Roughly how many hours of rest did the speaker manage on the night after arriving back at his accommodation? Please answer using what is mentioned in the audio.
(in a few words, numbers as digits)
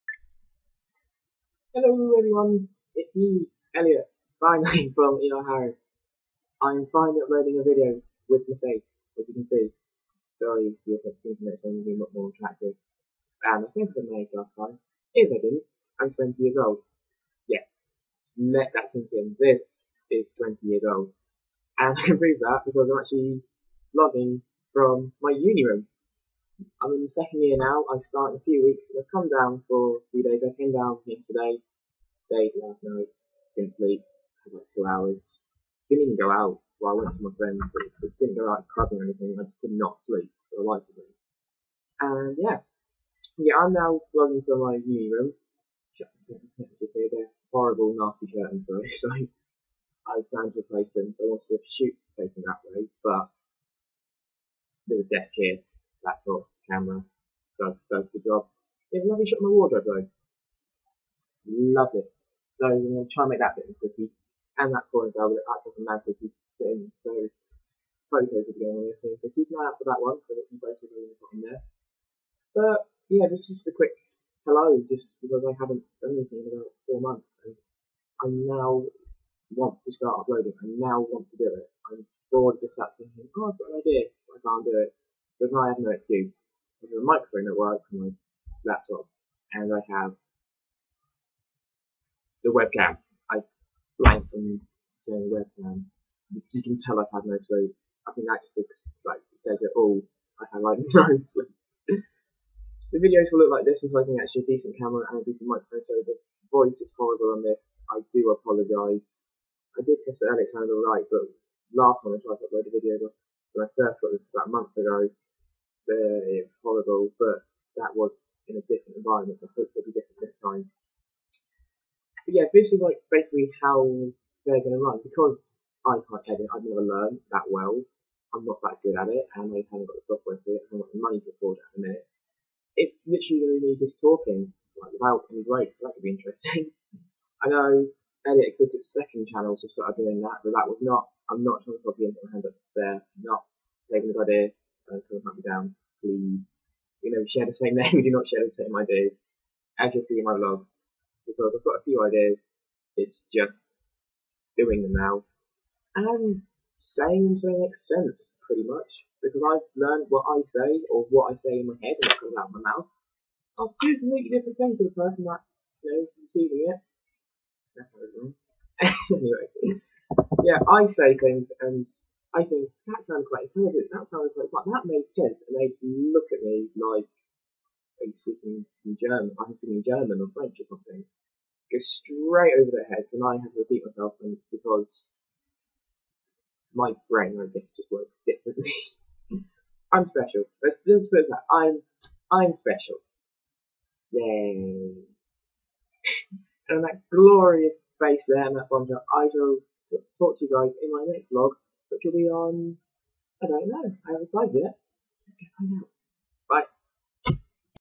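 2.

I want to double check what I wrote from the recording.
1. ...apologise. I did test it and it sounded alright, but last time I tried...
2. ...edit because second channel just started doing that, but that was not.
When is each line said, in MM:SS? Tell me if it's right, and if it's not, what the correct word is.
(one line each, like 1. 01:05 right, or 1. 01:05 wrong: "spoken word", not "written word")
1. 01:48 right
2. 02:18 right.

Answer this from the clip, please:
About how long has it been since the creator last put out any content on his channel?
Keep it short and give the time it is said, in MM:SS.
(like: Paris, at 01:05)
4 months, at 01:16.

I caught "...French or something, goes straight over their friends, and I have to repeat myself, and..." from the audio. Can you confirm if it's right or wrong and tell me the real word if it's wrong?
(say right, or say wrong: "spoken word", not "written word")
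wrong: "heads", not "friends".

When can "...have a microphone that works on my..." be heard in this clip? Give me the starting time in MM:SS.
01:26.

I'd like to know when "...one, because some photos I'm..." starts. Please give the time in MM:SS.
01:09.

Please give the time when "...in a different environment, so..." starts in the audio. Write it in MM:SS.
01:58.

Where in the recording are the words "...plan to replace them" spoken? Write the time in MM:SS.
00:50.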